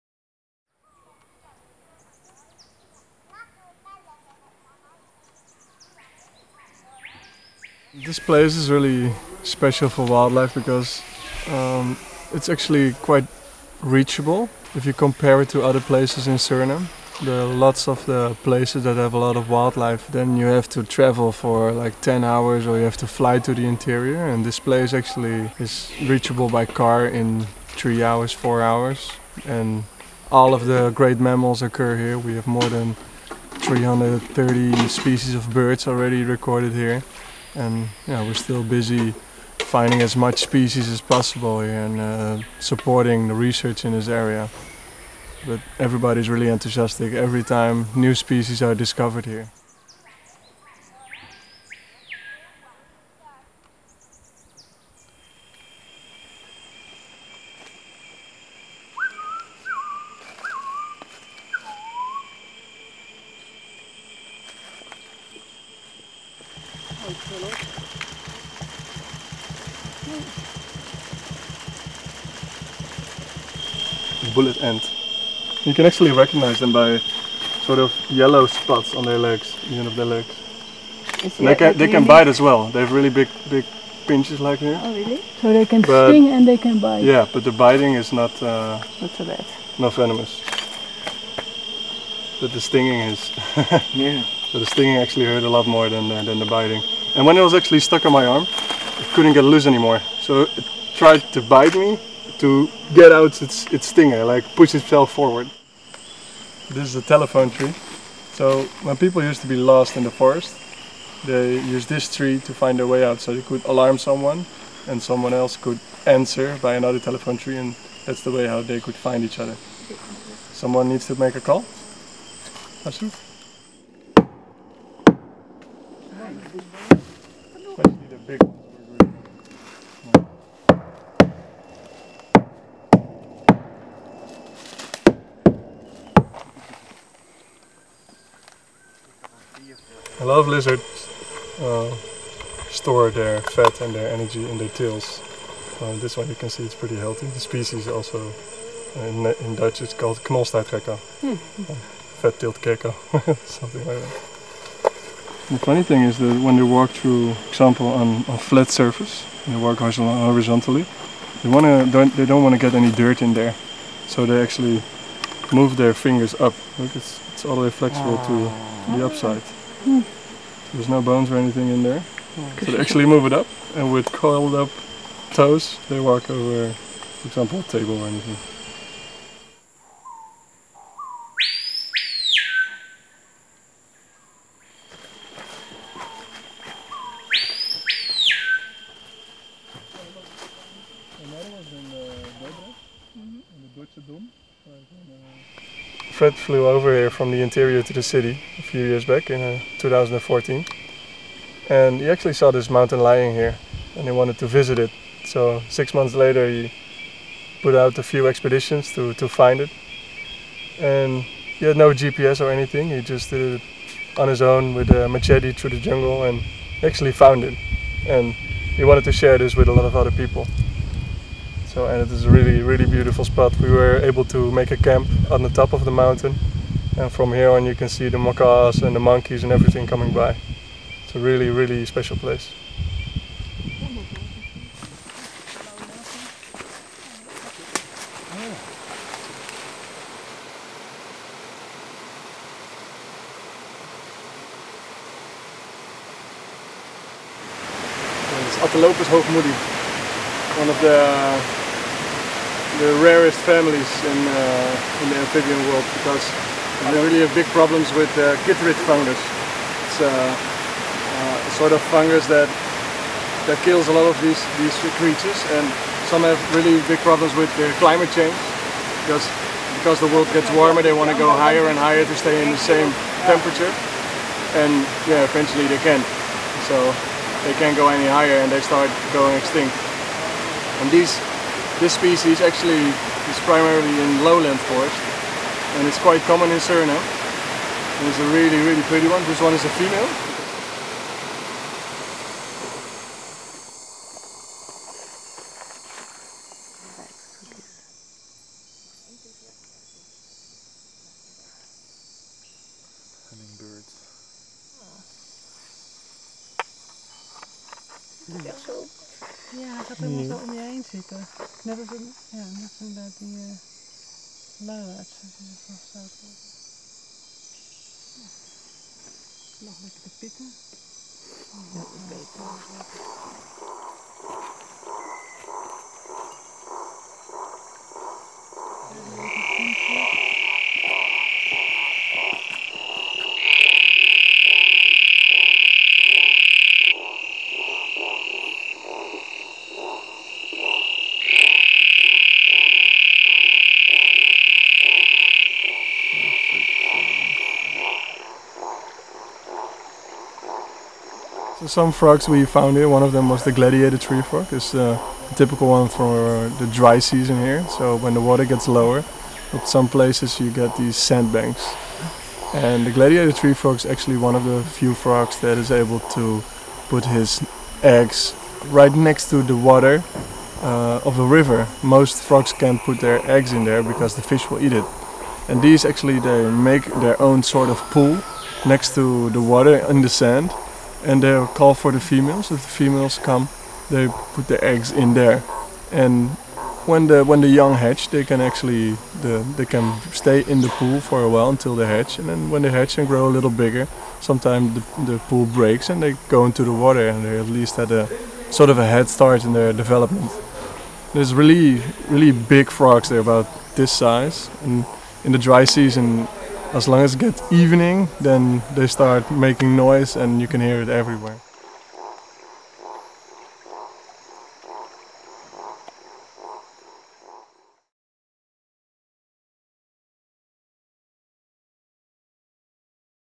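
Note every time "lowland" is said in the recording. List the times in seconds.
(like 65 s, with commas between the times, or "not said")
284 s.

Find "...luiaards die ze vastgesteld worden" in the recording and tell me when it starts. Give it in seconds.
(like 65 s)
314 s.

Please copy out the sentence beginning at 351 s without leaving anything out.
So some frogs we found here, one of them was the gladiator tree frog.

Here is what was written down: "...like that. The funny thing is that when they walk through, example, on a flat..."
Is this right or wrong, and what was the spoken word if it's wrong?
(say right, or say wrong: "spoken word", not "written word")
right.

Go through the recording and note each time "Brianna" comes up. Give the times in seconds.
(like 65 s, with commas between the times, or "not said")
not said.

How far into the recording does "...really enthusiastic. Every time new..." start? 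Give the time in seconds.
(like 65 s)
46 s.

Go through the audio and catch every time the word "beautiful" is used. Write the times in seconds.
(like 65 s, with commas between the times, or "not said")
222 s.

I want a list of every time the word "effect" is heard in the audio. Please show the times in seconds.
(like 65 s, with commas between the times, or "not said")
not said.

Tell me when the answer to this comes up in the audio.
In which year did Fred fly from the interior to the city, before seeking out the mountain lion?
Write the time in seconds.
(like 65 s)
199 s.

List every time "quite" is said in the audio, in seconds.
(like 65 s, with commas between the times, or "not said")
12 s, 285 s.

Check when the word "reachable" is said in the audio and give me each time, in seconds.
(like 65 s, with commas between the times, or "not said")
13 s, 26 s.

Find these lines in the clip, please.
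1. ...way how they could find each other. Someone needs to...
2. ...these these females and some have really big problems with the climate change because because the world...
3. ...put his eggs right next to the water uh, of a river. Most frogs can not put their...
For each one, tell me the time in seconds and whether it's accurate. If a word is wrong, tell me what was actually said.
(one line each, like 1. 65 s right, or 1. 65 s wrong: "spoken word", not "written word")
1. 118 s right
2. 264 s wrong: "creatures", not "females"
3. 366 s right.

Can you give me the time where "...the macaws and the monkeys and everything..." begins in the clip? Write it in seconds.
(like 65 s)
228 s.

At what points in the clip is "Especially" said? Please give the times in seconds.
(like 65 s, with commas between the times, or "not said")
126 s.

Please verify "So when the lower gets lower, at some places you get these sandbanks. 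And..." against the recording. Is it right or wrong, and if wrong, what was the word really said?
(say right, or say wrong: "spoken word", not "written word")
wrong: "water", not "lower".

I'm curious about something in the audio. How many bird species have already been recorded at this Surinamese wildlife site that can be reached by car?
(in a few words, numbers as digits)
more than 330.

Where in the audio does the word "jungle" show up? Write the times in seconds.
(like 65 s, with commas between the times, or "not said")
215 s.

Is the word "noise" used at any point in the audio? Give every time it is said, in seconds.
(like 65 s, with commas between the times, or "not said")
409 s.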